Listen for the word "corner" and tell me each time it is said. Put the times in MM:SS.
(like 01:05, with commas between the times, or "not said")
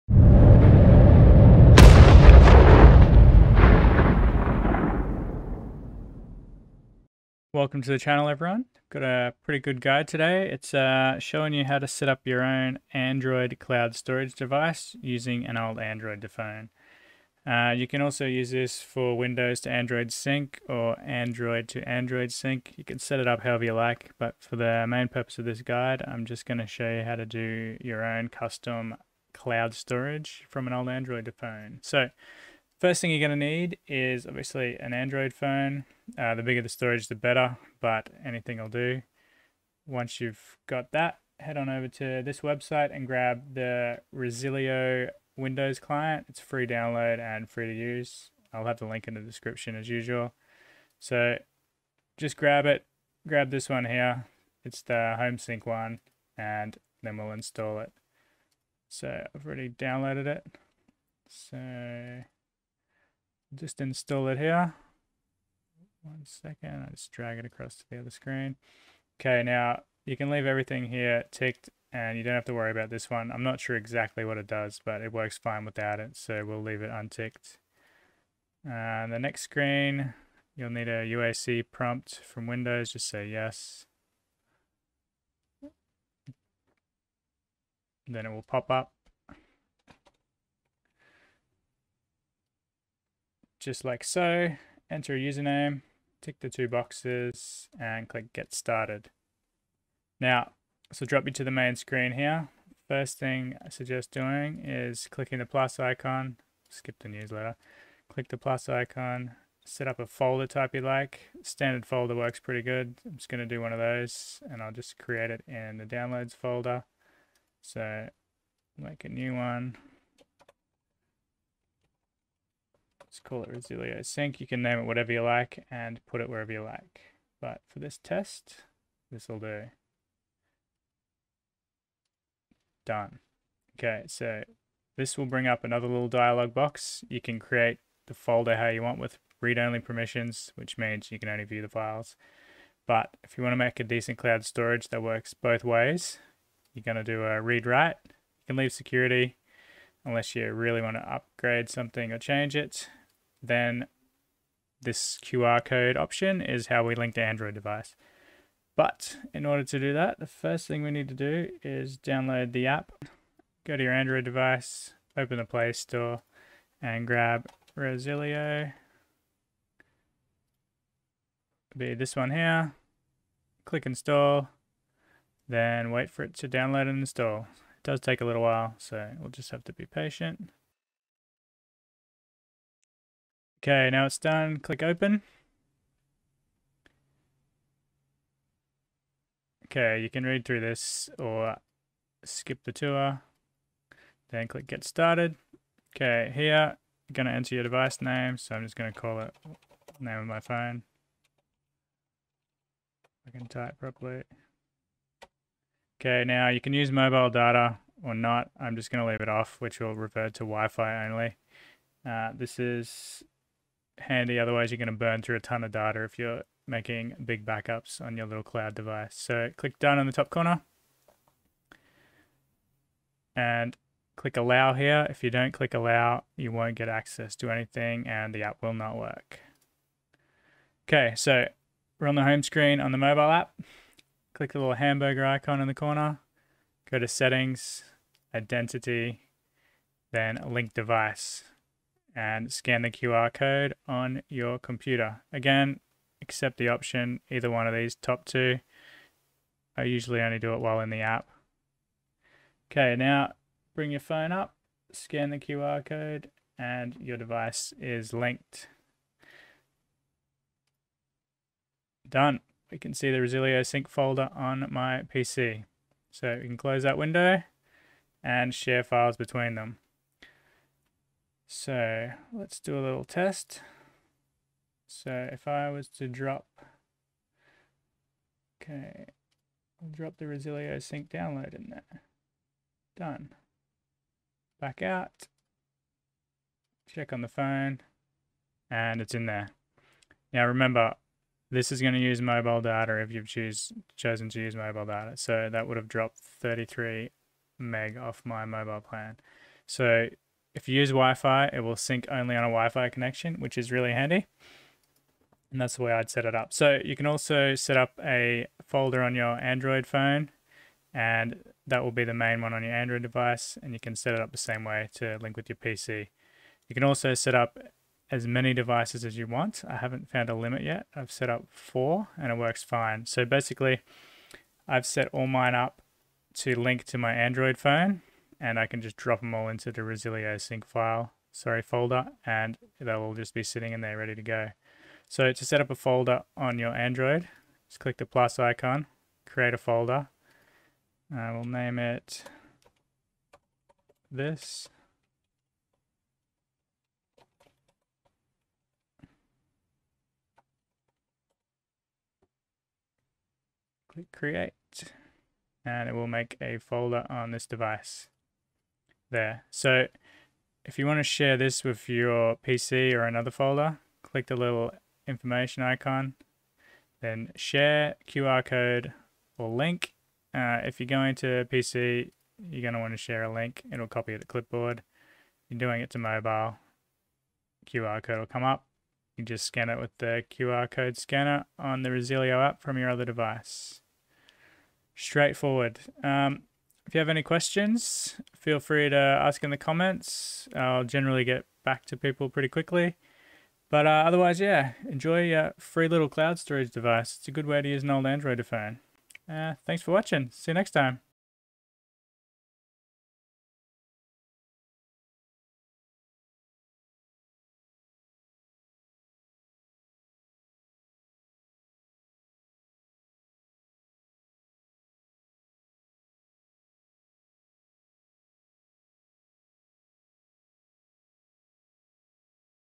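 03:40, 03:55.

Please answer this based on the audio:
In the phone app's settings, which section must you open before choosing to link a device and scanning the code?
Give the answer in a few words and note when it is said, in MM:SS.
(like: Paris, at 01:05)
identity, at 03:58.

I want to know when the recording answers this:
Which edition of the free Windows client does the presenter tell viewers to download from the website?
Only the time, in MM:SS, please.
00:55.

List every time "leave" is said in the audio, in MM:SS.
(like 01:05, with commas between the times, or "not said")
01:10, 01:16, 02:28, 03:29.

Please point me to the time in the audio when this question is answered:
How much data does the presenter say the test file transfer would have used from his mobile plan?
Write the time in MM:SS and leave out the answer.
04:56.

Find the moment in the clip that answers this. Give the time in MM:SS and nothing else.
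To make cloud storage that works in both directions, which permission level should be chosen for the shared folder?
02:27.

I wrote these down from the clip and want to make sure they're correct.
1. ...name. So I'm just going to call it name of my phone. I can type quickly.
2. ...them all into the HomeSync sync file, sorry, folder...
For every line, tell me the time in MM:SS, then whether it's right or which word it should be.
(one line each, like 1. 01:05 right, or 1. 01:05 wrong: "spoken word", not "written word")
1. 03:18 wrong: "properly", not "quickly"
2. 05:29 wrong: "Resilio", not "HomeSync".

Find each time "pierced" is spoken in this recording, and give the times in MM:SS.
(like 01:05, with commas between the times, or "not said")
not said.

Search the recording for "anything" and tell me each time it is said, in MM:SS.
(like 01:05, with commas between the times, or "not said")
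00:38, 03:47.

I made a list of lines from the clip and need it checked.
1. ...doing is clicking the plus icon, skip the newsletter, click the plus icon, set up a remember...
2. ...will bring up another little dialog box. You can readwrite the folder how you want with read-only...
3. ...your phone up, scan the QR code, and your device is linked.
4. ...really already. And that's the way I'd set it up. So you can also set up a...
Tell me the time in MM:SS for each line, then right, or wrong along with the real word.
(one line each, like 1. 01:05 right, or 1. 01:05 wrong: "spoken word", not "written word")
1. 01:44 wrong: "folder", not "remember"
2. 02:15 wrong: "create", not "readwrite"
3. 04:13 right
4. 05:03 wrong: "handy", not "already".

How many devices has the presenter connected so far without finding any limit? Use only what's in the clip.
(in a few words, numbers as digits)
4.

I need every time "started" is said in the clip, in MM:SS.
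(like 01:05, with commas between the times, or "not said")
01:38, 03:14.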